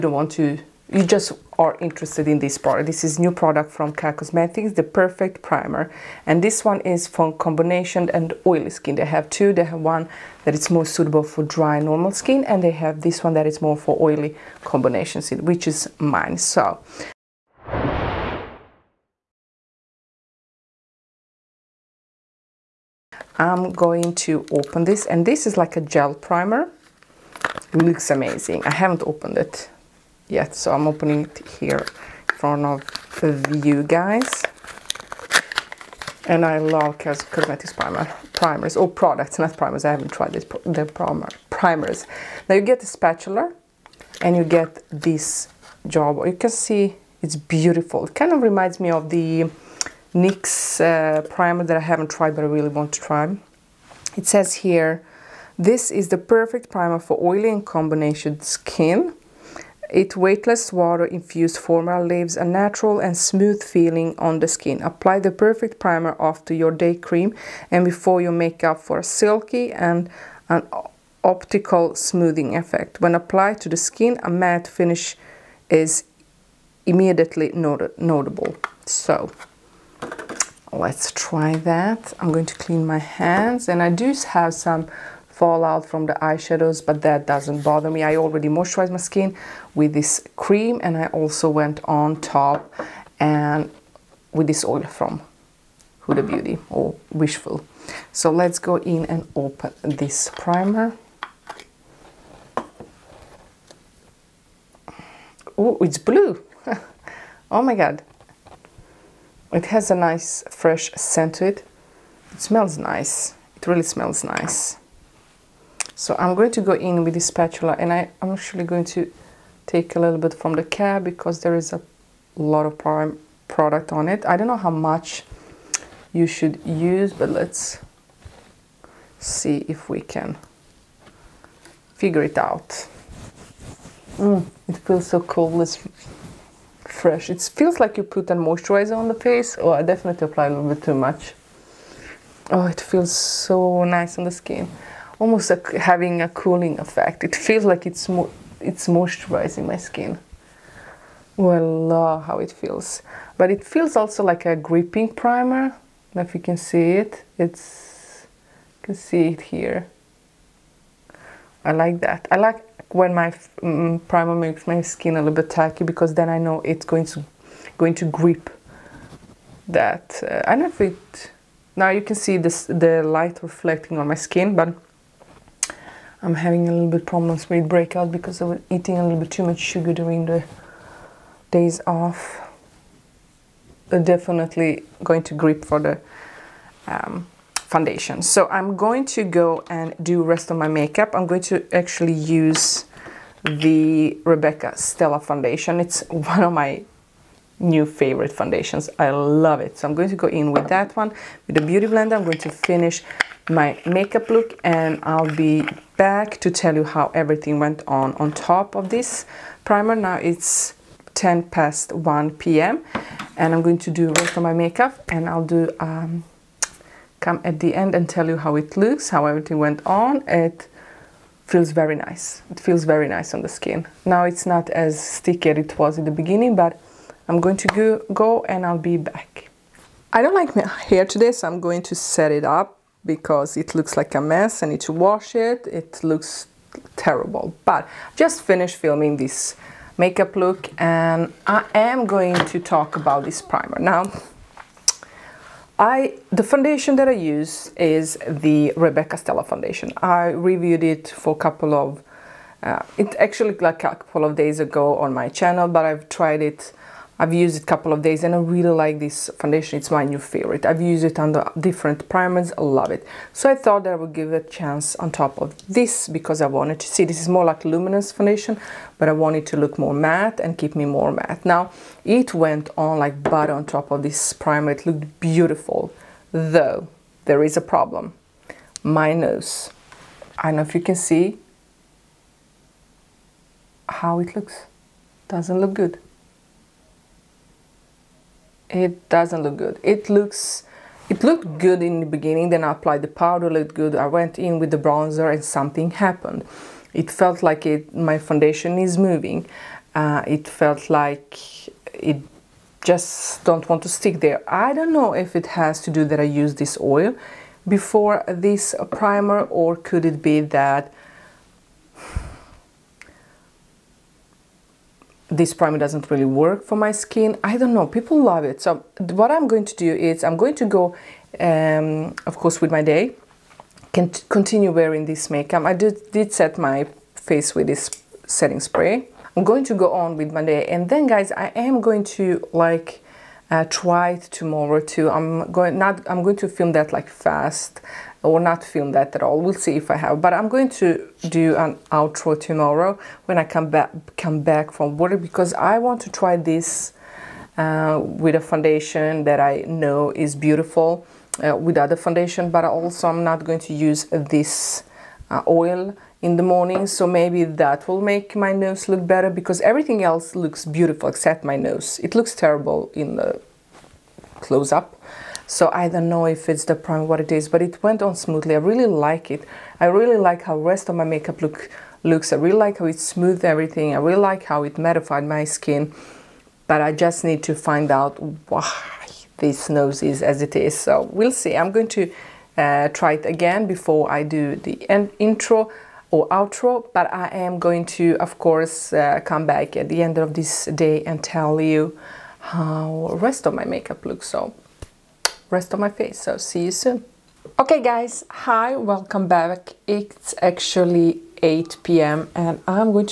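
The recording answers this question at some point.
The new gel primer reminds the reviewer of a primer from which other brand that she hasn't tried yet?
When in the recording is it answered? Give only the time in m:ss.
0:50.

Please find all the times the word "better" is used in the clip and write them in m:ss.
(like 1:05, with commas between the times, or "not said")
5:59.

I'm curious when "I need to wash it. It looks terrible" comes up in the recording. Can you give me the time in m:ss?
3:54.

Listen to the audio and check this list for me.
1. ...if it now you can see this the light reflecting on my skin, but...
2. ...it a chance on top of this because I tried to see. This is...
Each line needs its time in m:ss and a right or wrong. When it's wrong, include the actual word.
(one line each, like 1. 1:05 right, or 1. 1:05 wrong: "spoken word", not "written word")
1. 2:50 right
2. 4:24 wrong: "wanted", not "tried".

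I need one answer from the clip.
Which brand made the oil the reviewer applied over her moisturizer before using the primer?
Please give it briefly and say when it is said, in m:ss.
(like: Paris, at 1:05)
Huda Beauty, at 1:36.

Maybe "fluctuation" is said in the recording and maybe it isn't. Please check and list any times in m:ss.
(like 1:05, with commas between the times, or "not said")
not said.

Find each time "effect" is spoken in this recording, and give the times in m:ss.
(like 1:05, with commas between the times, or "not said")
1:12, 2:26.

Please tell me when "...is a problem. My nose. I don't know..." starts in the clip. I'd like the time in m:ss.
4:37.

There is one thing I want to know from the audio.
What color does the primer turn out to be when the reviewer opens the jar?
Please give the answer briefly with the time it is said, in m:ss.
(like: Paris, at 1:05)
Blue, at 1:45.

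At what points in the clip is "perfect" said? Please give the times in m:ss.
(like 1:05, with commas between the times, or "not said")
0:04, 0:56, 1:05.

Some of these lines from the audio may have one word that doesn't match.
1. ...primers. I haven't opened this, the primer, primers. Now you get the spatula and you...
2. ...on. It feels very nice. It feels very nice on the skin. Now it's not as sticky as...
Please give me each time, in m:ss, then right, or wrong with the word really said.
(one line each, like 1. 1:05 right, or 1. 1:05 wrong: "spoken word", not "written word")
1. 0:39 wrong: "tried", not "opened"
2. 3:39 right.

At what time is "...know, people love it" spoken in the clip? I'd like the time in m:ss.
5:17.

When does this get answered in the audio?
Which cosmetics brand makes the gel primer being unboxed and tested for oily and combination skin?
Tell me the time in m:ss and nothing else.
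0:03.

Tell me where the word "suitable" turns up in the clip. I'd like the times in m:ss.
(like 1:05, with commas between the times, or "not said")
0:10.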